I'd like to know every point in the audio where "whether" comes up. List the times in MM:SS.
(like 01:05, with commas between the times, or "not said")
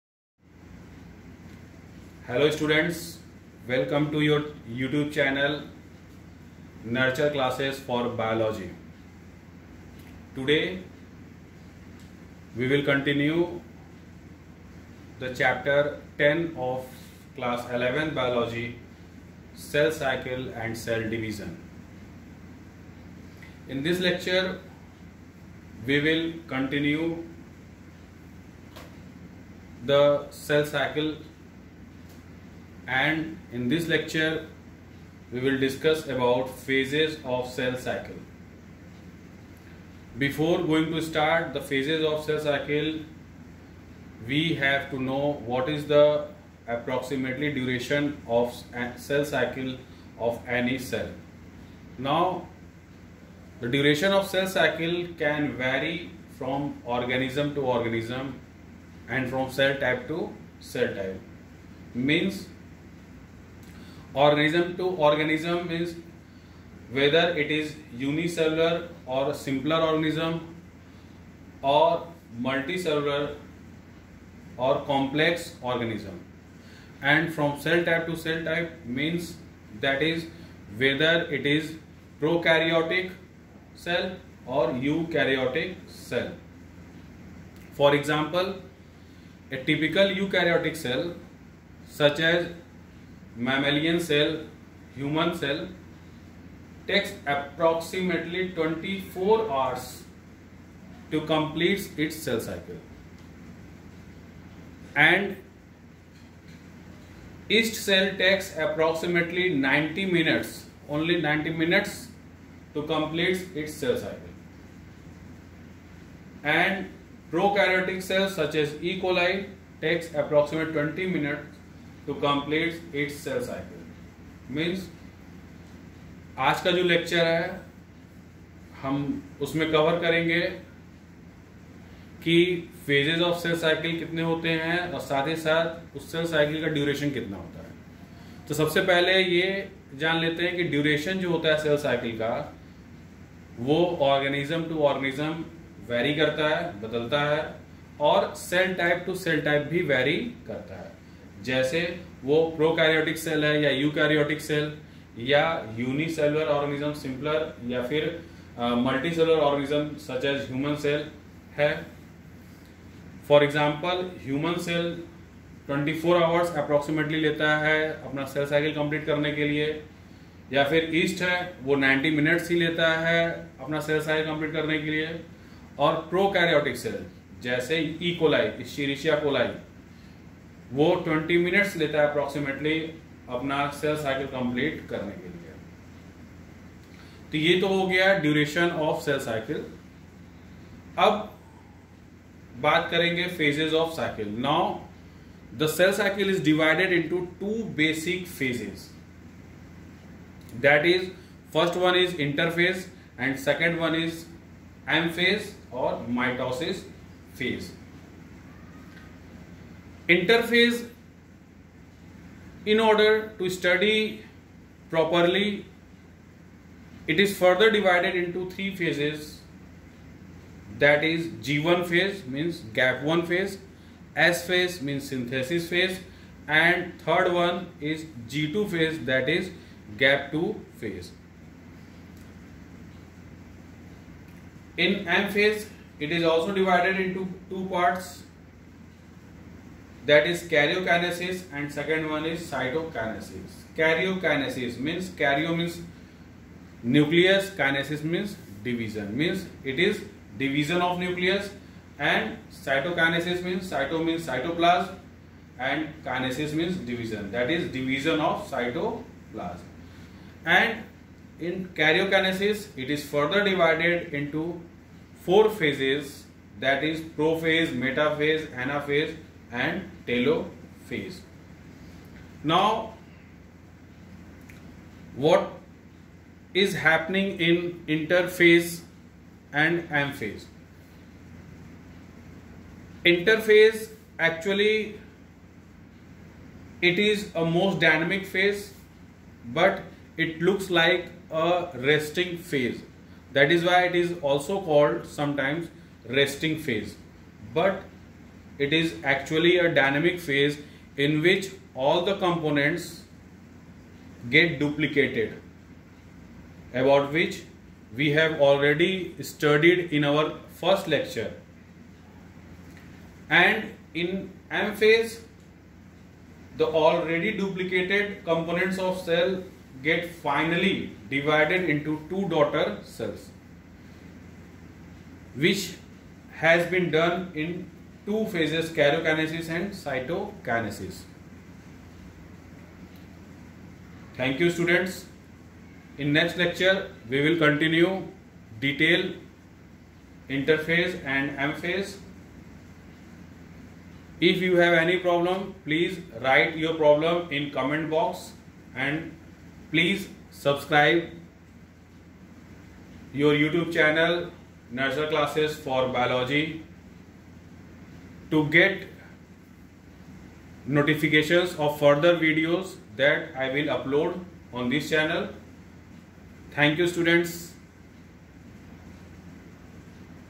01:06, 01:20.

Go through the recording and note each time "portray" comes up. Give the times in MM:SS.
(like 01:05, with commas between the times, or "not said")
not said.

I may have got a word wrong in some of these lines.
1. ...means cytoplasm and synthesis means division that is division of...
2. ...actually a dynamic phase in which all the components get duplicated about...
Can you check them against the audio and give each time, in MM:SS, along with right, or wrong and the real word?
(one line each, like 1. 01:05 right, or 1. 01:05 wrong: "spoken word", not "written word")
1. 04:14 wrong: "kinesis", not "synthesis"
2. 04:59 right.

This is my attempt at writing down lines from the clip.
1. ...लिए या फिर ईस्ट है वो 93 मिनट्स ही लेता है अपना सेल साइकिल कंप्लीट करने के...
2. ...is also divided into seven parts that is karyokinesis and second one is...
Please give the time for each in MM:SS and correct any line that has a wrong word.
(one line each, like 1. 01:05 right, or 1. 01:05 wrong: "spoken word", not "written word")
1. 02:49 wrong: "90", not "93"
2. 03:56 wrong: "two", not "seven".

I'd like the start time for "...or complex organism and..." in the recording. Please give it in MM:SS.
01:14.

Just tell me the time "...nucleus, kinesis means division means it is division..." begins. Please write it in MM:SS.
04:06.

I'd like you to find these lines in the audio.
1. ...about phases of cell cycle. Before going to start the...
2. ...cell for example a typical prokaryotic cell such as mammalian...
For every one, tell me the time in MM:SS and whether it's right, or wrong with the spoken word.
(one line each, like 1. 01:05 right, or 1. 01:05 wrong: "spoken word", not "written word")
1. 00:36 right
2. 01:25 wrong: "eukaryotic", not "prokaryotic".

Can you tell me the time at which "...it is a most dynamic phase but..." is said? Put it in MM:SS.
04:46.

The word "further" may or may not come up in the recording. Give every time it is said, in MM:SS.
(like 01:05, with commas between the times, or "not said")
03:37, 04:23, 06:01.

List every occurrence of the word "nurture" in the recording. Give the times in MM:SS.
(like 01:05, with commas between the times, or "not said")
00:06, 05:54.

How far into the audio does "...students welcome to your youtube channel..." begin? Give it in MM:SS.
00:02.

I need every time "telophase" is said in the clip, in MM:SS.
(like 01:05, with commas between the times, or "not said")
04:30.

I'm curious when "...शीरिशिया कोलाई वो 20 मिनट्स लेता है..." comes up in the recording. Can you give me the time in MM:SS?
02:58.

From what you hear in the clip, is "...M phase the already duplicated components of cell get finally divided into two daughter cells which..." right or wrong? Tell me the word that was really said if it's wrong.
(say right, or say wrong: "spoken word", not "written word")
right.